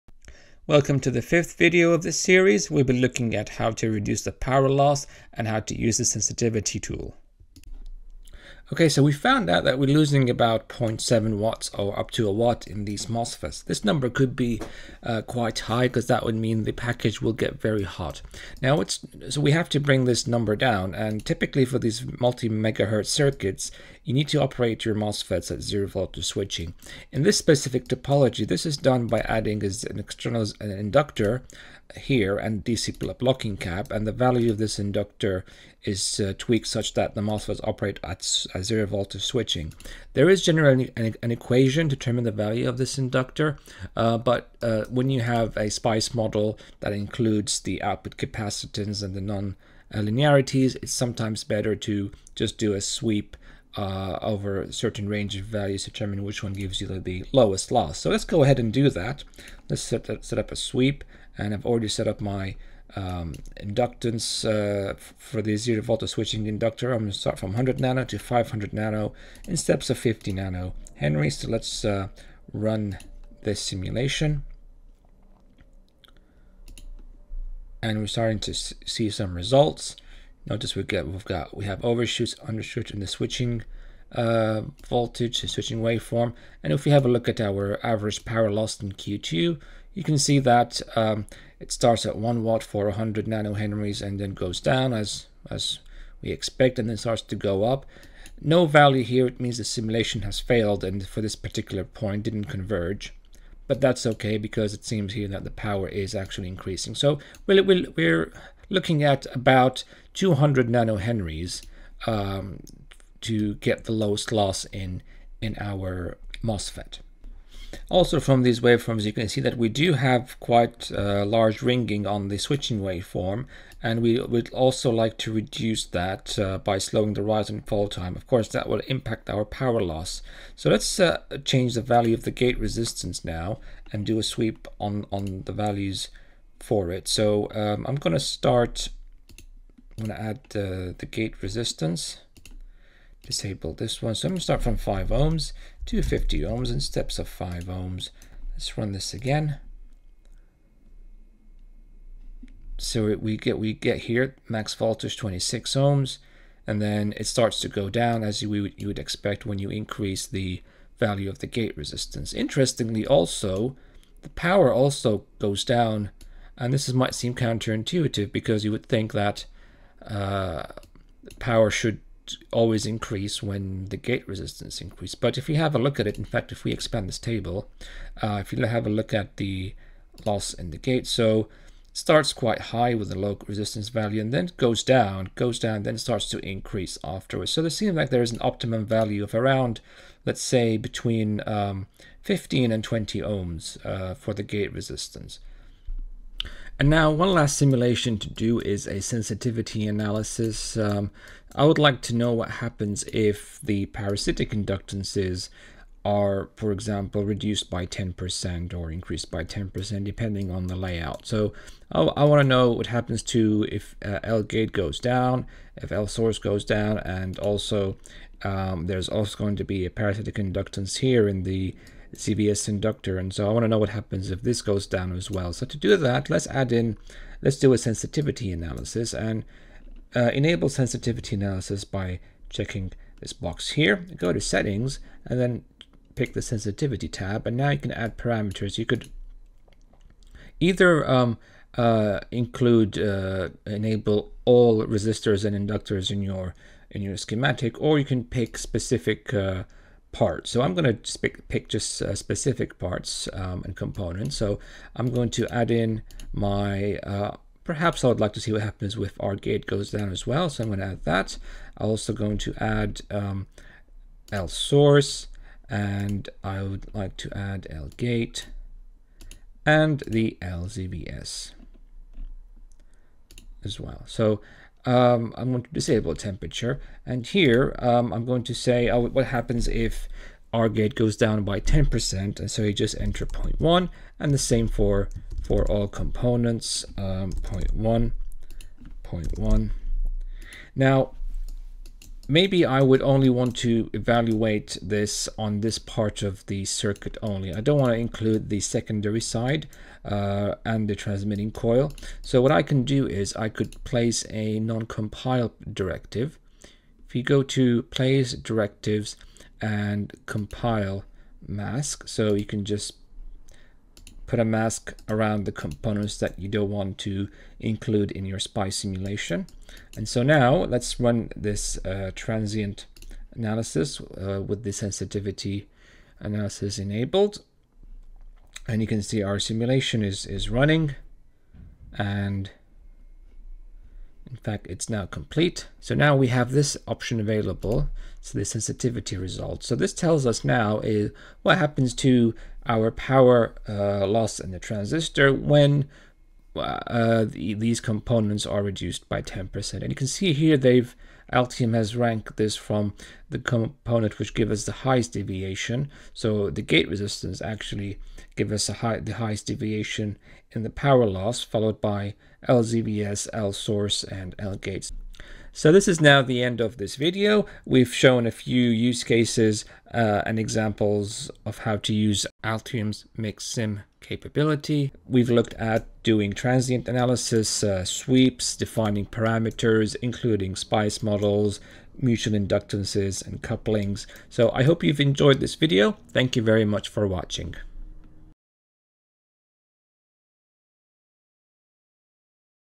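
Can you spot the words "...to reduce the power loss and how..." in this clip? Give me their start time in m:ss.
0:03.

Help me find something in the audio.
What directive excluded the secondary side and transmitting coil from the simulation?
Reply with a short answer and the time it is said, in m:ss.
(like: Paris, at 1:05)
compile mask, at 5:10.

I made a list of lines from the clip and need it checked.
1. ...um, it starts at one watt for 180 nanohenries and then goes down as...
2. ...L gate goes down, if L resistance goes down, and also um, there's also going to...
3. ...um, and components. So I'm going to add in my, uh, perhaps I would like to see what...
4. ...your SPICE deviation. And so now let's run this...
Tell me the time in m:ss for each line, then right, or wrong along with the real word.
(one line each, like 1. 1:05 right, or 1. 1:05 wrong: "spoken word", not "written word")
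1. 1:30 wrong: "100", not "180"
2. 3:34 wrong: "source", not "resistance"
3. 4:13 right
4. 5:18 wrong: "simulation", not "deviation".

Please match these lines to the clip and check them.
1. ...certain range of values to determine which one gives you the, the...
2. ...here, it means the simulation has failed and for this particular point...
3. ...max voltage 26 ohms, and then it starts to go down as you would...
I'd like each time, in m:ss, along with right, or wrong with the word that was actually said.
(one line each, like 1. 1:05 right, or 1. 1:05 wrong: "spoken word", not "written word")
1. 0:54 right
2. 1:39 right
3. 2:34 right.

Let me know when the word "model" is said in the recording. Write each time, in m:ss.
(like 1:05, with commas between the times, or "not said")
0:46, 6:21.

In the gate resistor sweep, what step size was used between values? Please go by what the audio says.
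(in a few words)
5 ohms.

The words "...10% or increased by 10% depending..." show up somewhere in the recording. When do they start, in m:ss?
3:27.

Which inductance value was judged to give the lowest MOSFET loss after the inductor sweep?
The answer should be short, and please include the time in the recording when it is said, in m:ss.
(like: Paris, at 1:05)
200 nanohenries, at 1:50.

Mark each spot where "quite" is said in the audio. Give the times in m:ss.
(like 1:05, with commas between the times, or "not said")
0:15, 2:00, 3:02.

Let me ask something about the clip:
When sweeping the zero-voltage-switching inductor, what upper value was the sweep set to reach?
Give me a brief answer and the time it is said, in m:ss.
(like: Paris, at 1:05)
500 nH, at 1:08.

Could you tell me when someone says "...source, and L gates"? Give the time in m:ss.
6:03.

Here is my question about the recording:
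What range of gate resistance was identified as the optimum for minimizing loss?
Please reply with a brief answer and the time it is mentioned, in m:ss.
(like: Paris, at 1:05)
15 to 20 ohms, at 3:10.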